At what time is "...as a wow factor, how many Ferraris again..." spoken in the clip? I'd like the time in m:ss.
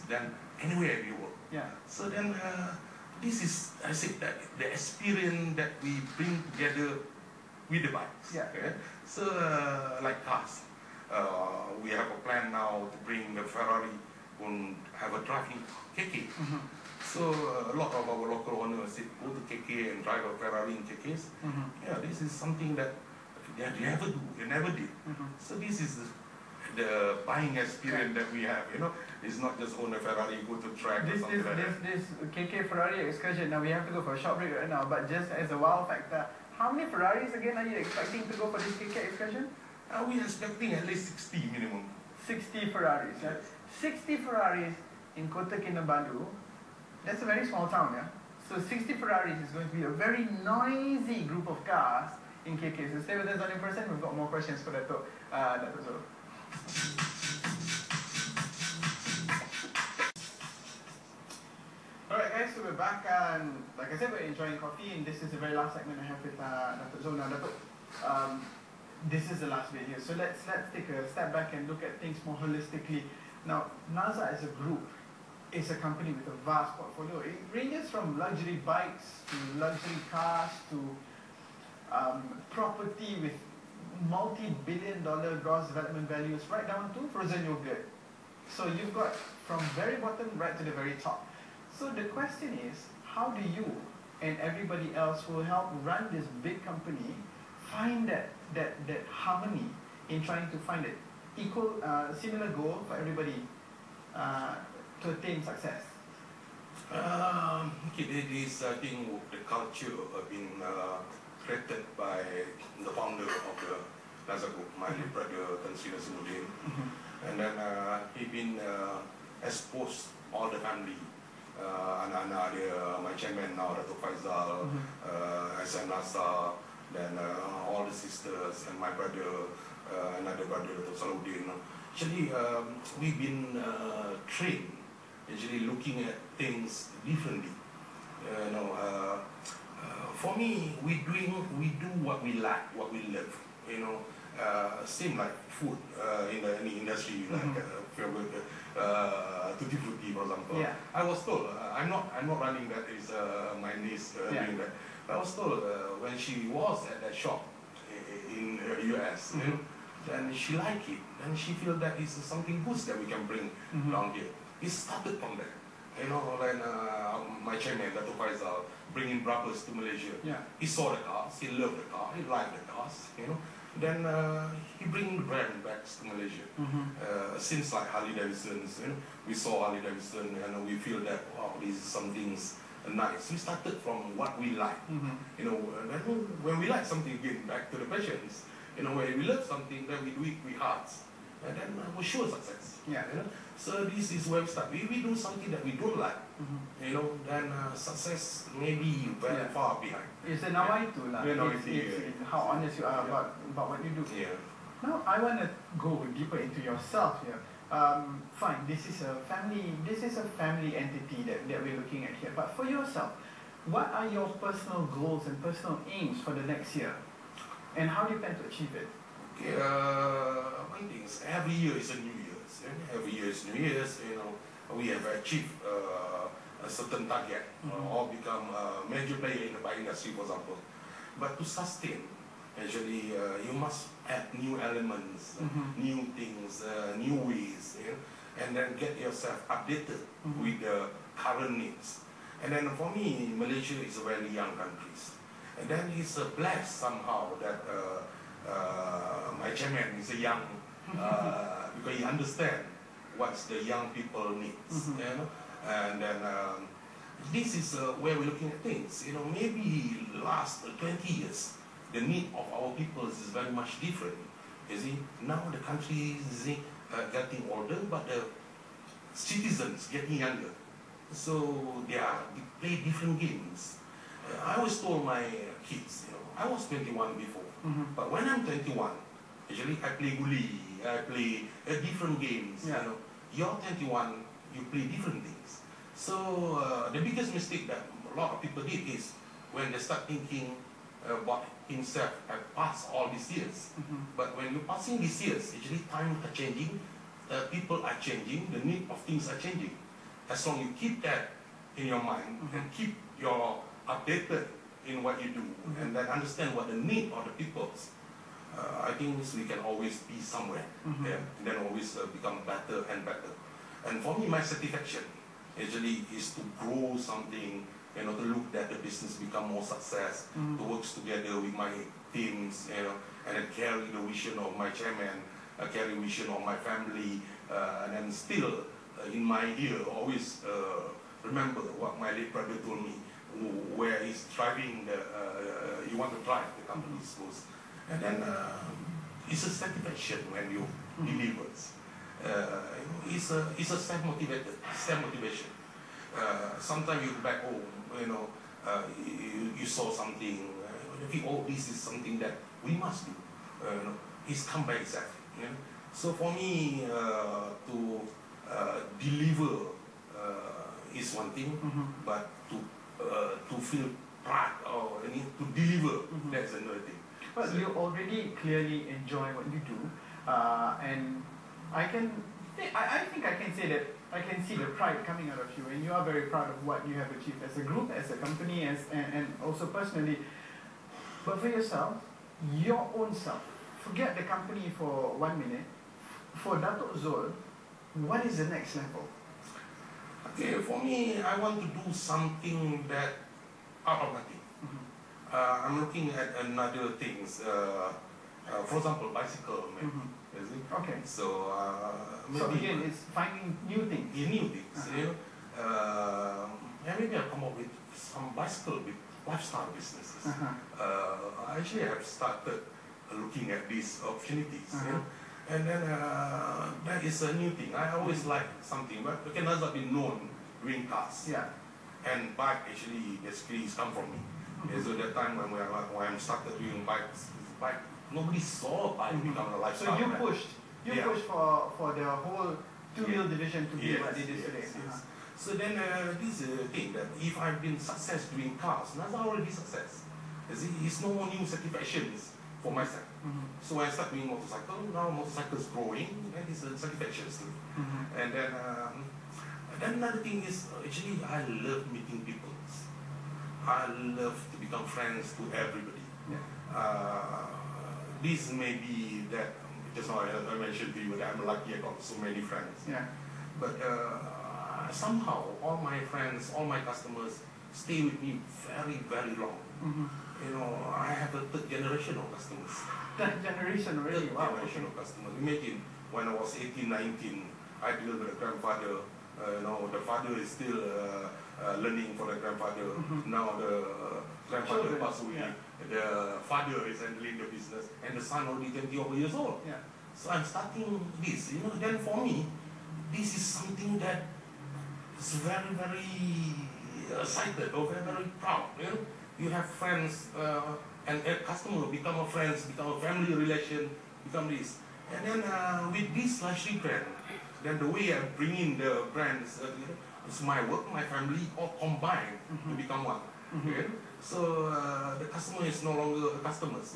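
0:35.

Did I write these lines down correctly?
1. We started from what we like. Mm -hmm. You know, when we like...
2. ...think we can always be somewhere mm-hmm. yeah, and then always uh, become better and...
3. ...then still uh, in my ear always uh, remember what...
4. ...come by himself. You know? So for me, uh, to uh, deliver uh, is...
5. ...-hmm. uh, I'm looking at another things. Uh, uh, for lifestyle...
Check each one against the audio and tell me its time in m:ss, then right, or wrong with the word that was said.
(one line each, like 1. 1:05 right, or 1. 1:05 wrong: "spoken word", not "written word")
1. 3:03 right
2. 5:08 right
3. 5:27 right
4. 5:54 wrong: "itself", not "himself"
5. 6:34 wrong: "example", not "lifestyle".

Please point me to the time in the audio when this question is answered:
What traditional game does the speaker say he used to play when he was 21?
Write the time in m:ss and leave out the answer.
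4:40.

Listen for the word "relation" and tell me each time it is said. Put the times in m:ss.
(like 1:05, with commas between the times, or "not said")
8:23.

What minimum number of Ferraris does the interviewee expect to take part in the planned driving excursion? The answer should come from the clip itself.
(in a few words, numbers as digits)
60.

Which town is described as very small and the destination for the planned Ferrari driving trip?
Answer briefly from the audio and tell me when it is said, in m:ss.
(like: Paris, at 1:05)
Kota Kinabalu, at 0:45.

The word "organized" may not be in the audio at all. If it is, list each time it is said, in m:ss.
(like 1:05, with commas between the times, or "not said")
not said.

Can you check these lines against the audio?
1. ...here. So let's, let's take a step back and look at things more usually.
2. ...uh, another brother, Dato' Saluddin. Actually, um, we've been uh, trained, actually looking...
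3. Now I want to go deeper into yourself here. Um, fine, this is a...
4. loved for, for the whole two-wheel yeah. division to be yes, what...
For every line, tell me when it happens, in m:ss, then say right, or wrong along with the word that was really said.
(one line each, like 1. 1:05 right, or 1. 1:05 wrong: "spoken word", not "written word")
1. 1:09 wrong: "holistically", not "usually"
2. 2:09 right
3. 3:24 right
4. 7:11 wrong: "pushed", not "loved".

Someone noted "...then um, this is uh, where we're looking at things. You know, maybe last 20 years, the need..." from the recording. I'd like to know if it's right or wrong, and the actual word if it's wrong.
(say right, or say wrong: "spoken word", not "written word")
right.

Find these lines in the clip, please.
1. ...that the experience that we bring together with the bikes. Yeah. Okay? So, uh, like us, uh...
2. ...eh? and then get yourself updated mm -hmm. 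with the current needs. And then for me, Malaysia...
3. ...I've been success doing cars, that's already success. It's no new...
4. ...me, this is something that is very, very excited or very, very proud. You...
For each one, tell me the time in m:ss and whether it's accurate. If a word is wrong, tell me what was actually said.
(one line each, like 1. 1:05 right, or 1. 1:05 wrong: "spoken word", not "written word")
1. 0:04 right
2. 3:57 right
3. 7:17 right
4. 8:12 right.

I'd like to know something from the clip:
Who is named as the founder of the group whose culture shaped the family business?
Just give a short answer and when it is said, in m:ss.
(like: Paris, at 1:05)
Tan Sri Nasruddin, at 1:55.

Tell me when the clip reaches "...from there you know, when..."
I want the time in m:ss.
2:45.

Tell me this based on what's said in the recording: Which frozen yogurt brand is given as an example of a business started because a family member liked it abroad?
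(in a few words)
Tutti Frutti.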